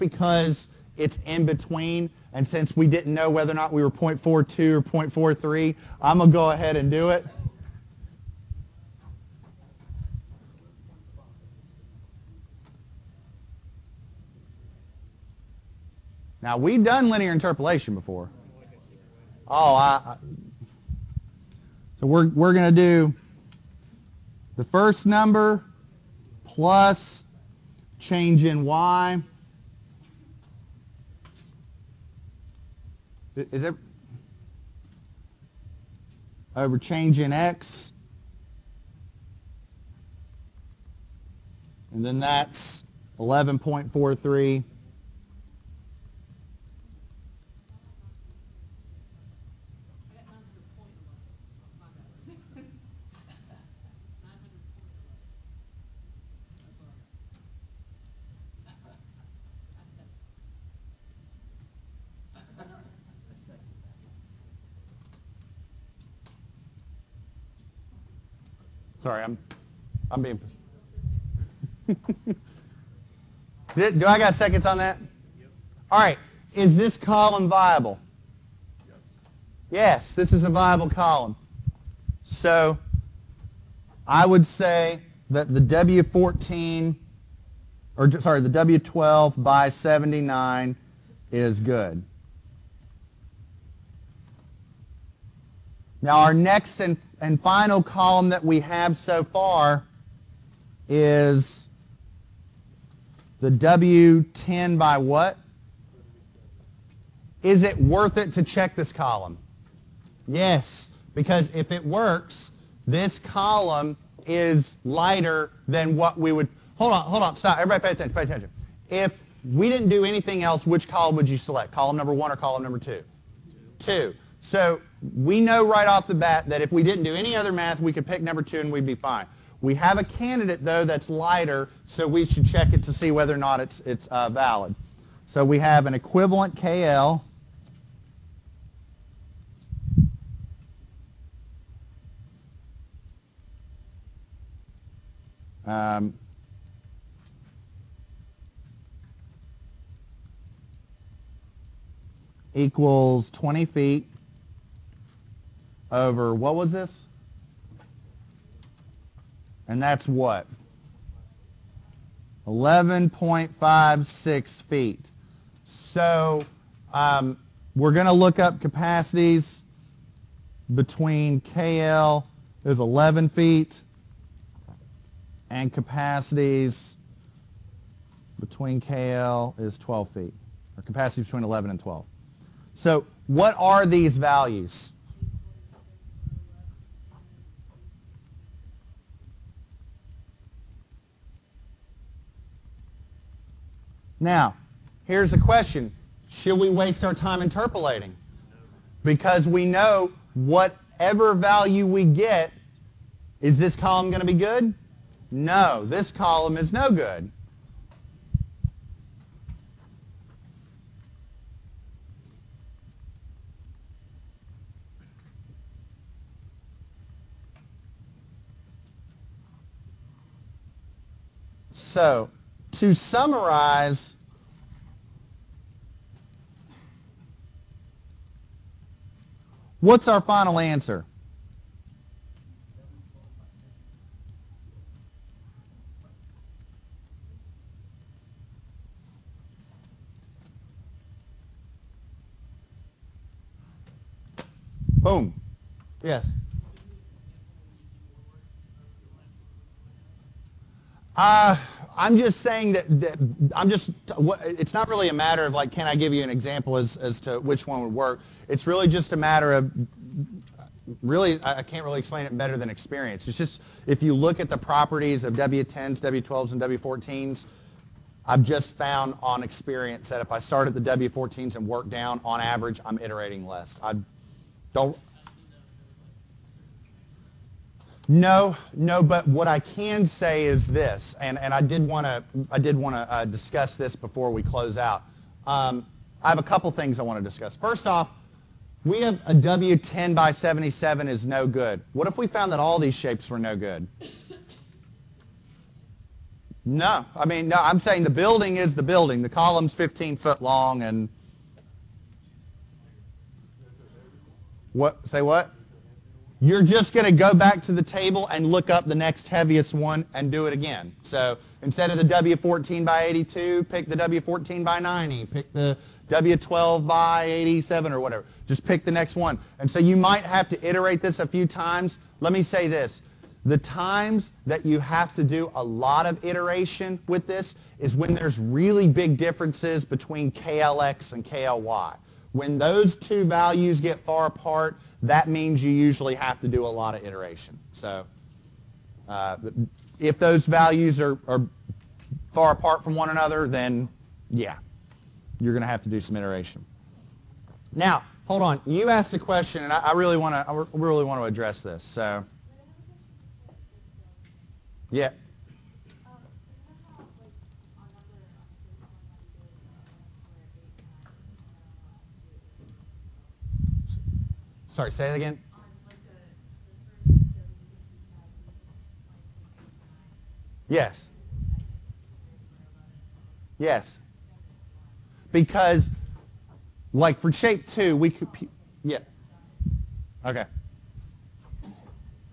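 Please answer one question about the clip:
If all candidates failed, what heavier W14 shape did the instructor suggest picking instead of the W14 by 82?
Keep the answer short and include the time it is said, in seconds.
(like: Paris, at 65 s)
W14 by 90, at 313 s.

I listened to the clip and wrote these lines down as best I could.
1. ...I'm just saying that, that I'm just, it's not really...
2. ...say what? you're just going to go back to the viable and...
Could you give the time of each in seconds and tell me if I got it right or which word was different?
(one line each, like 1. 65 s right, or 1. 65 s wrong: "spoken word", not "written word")
1. 251 s right
2. 305 s wrong: "table", not "viable".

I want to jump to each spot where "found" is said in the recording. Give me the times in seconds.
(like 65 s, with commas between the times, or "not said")
268 s, 292 s.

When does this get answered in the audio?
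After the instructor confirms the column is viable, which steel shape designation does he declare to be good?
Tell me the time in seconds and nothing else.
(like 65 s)
88 s.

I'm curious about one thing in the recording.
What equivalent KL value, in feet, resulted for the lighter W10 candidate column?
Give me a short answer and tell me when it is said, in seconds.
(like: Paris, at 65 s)
11.56 feet, at 162 s.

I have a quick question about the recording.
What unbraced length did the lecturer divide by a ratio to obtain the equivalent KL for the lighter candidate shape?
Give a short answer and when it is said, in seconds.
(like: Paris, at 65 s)
20 feet, at 153 s.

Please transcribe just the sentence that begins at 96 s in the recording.
Now our next and and final column that we have so far is the W10 by what?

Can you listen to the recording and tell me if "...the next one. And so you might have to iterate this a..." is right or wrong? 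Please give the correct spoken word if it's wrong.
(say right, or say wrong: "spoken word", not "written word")
right.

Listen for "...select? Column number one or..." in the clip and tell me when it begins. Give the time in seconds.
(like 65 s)
121 s.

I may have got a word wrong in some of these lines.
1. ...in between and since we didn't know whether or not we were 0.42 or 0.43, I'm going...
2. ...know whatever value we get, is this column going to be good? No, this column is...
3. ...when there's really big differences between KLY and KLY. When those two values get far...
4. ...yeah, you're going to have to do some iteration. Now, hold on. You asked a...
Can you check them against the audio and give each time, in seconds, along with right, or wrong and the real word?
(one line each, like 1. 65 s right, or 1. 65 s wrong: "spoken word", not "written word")
1. 1 s right
2. 199 s right
3. 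327 s wrong: "KLX", not "KLY"
4. 344 s right.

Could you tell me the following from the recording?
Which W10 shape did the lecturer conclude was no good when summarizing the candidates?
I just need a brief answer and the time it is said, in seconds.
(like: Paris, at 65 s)
W10 by 77, at 289 s.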